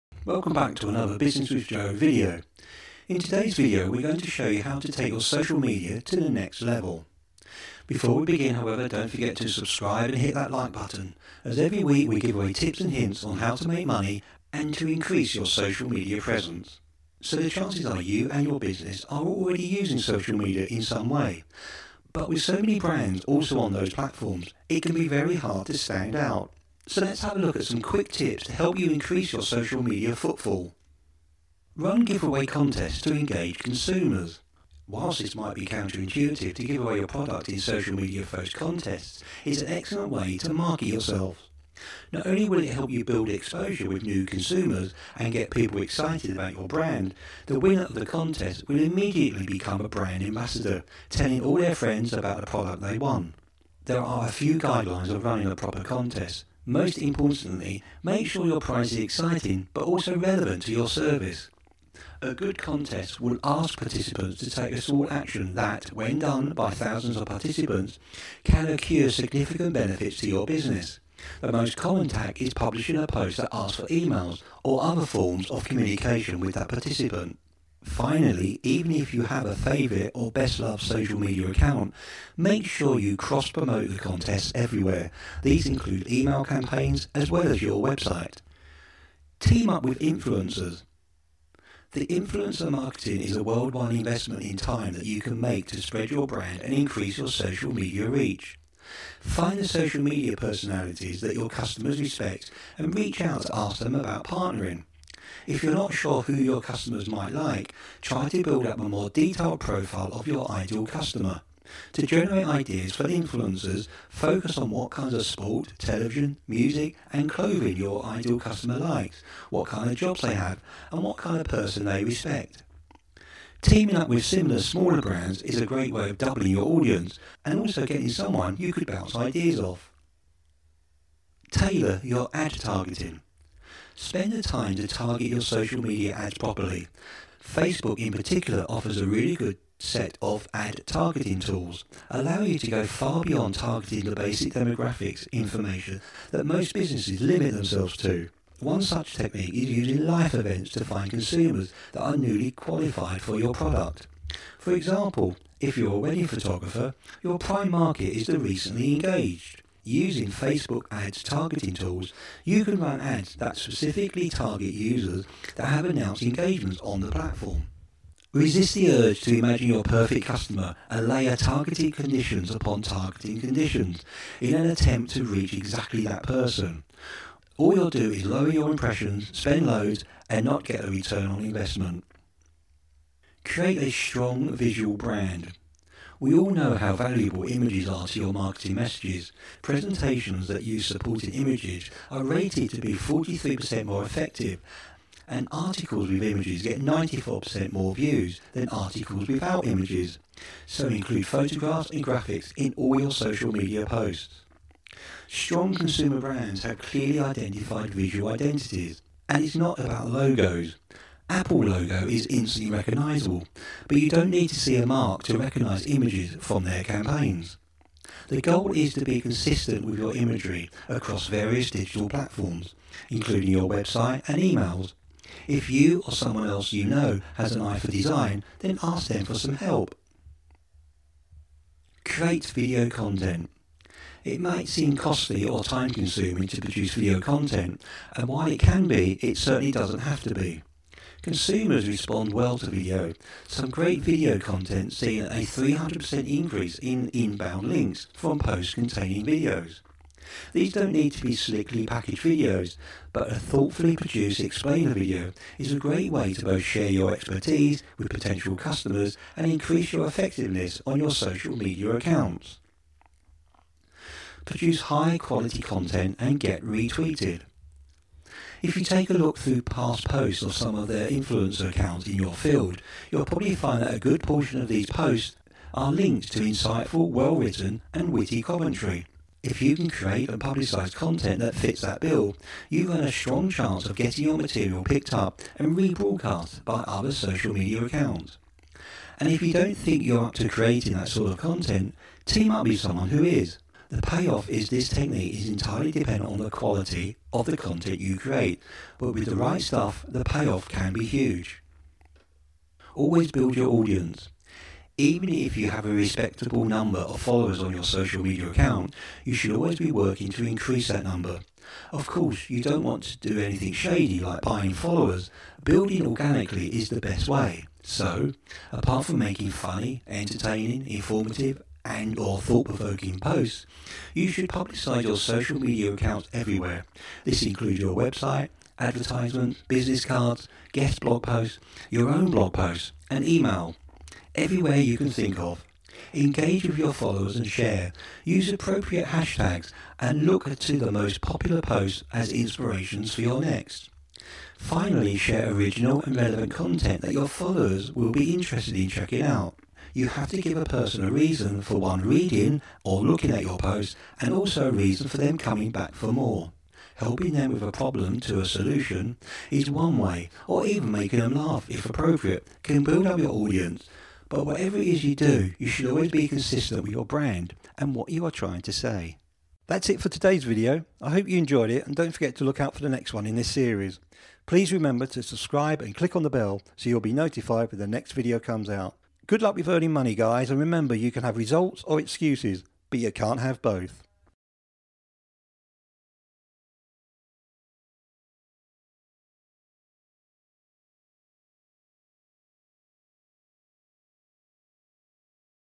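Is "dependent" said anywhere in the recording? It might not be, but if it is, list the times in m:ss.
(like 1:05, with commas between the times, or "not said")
4:55.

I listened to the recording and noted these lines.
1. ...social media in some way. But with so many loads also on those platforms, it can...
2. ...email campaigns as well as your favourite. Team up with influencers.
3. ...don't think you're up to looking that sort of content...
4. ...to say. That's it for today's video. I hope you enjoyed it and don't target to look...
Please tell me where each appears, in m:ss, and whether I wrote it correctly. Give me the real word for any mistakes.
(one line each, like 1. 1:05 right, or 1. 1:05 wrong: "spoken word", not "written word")
1. 0:19 wrong: "brands", not "loads"
2. 1:26 wrong: "website", not "favourite"
3. 4:49 wrong: "creating", not "looking"
4. 6:08 wrong: "forget", not "target".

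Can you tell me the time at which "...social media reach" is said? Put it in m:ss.
1:37.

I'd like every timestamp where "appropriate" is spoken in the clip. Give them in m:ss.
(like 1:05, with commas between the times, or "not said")
5:38, 6:01.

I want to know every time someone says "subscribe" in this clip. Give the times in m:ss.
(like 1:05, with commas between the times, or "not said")
0:09, 6:15.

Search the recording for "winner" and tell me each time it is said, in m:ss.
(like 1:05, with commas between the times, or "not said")
0:47.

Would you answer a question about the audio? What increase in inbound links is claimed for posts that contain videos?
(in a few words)
300%.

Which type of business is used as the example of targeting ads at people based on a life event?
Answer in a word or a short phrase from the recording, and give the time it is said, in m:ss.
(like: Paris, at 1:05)
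Wedding photographer, at 2:35.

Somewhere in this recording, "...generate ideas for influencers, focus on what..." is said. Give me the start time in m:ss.
1:52.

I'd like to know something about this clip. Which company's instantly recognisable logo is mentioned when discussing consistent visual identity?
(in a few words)
Apple.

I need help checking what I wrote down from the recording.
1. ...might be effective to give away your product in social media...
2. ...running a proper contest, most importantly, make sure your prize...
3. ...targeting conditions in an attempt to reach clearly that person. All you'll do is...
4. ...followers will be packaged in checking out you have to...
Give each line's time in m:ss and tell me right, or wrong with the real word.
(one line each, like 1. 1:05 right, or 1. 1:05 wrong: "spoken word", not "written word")
1. 0:35 wrong: "counterintuitive", not "effective"
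2. 0:55 right
3. 2:52 wrong: "exactly", not "clearly"
4. 5:47 wrong: "interested", not "packaged".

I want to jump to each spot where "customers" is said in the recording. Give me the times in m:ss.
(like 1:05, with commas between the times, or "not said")
1:41, 1:46, 1:50, 1:58, 2:50, 4:18.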